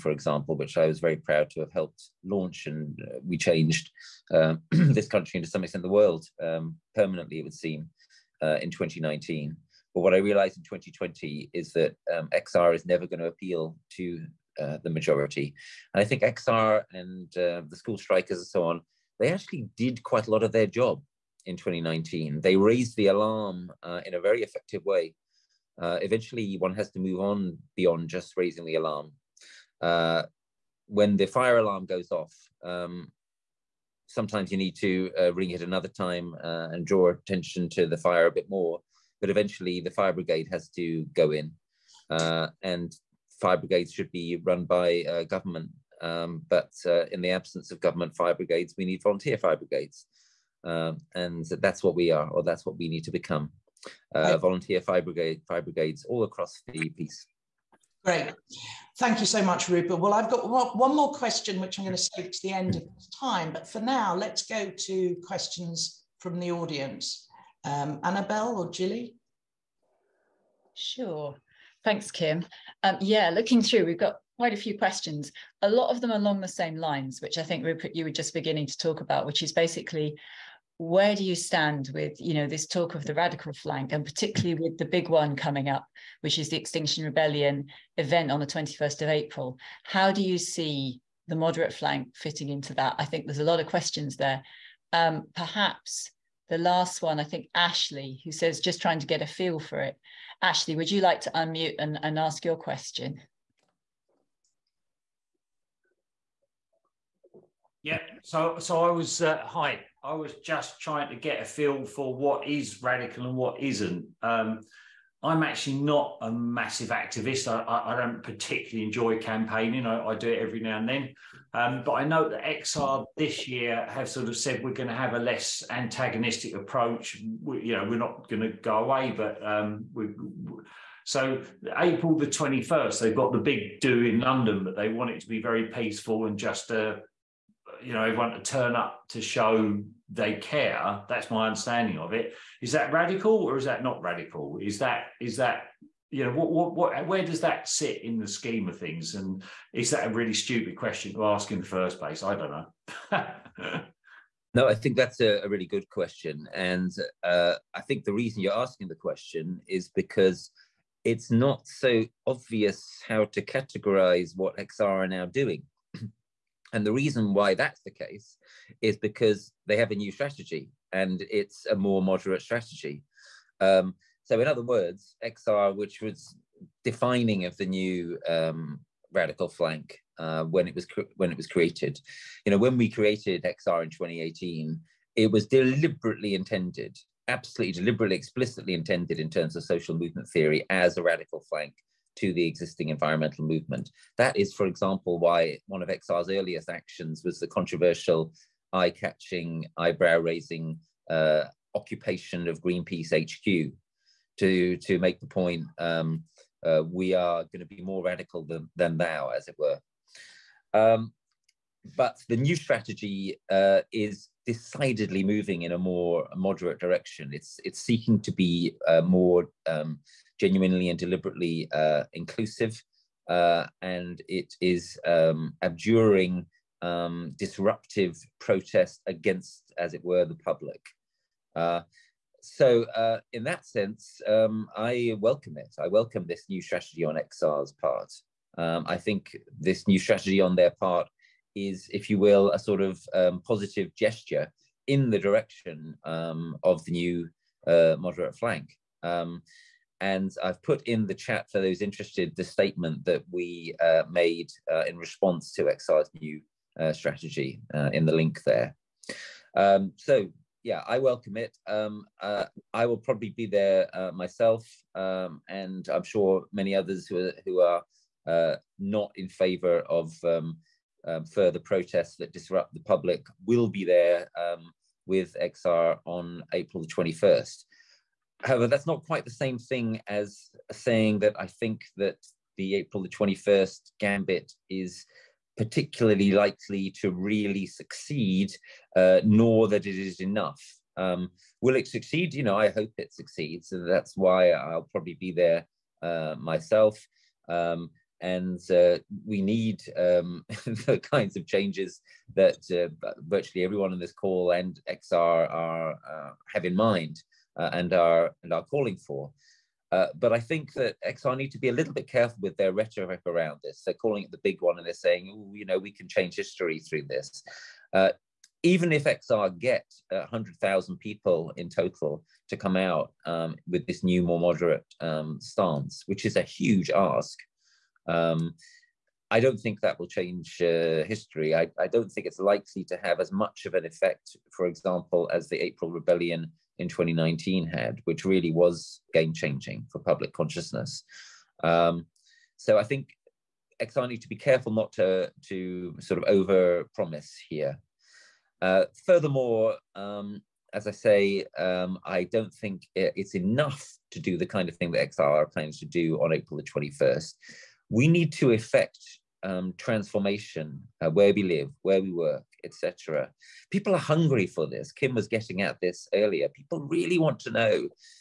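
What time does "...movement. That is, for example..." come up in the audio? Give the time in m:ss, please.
3:13.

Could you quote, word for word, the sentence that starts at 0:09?
But what I realized in 2020 is that um, XR is never going to appeal to uh, the majority.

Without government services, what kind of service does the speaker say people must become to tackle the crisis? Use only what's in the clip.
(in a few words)
volunteer fire brigades.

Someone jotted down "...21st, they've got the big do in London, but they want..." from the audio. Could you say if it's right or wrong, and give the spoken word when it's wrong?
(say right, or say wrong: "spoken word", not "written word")
right.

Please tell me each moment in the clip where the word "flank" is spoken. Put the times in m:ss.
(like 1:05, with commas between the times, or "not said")
1:23, 1:31, 2:59, 3:11, 4:08.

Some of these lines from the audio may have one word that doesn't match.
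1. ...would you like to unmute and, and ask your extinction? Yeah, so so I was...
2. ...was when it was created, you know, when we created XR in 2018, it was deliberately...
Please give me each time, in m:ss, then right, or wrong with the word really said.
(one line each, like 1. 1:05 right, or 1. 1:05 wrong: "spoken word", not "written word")
1. 1:40 wrong: "question", not "extinction"
2. 3:00 right.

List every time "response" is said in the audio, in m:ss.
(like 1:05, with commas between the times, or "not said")
4:14.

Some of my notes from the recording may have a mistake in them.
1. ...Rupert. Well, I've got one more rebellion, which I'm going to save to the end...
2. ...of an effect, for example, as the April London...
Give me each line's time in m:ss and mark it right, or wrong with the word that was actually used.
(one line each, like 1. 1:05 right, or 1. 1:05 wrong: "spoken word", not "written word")
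1. 0:59 wrong: "question", not "rebellion"
2. 5:33 wrong: "Rebellion", not "London".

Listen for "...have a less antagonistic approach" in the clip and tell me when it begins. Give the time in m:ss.
2:04.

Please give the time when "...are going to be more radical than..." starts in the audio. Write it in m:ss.
3:27.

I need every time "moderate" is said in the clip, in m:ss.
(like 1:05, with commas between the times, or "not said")
1:31, 2:52, 3:36, 4:07, 5:24.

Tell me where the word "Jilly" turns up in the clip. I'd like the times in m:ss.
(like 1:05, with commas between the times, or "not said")
1:08.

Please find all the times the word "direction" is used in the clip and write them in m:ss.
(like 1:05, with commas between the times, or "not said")
3:36, 4:05.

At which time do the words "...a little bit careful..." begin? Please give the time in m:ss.
5:11.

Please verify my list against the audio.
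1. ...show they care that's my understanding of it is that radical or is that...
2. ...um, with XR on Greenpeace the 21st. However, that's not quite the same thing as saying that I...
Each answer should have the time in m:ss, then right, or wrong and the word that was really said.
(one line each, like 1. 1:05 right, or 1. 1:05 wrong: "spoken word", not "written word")
1. 2:19 right
2. 4:34 wrong: "April", not "Greenpeace".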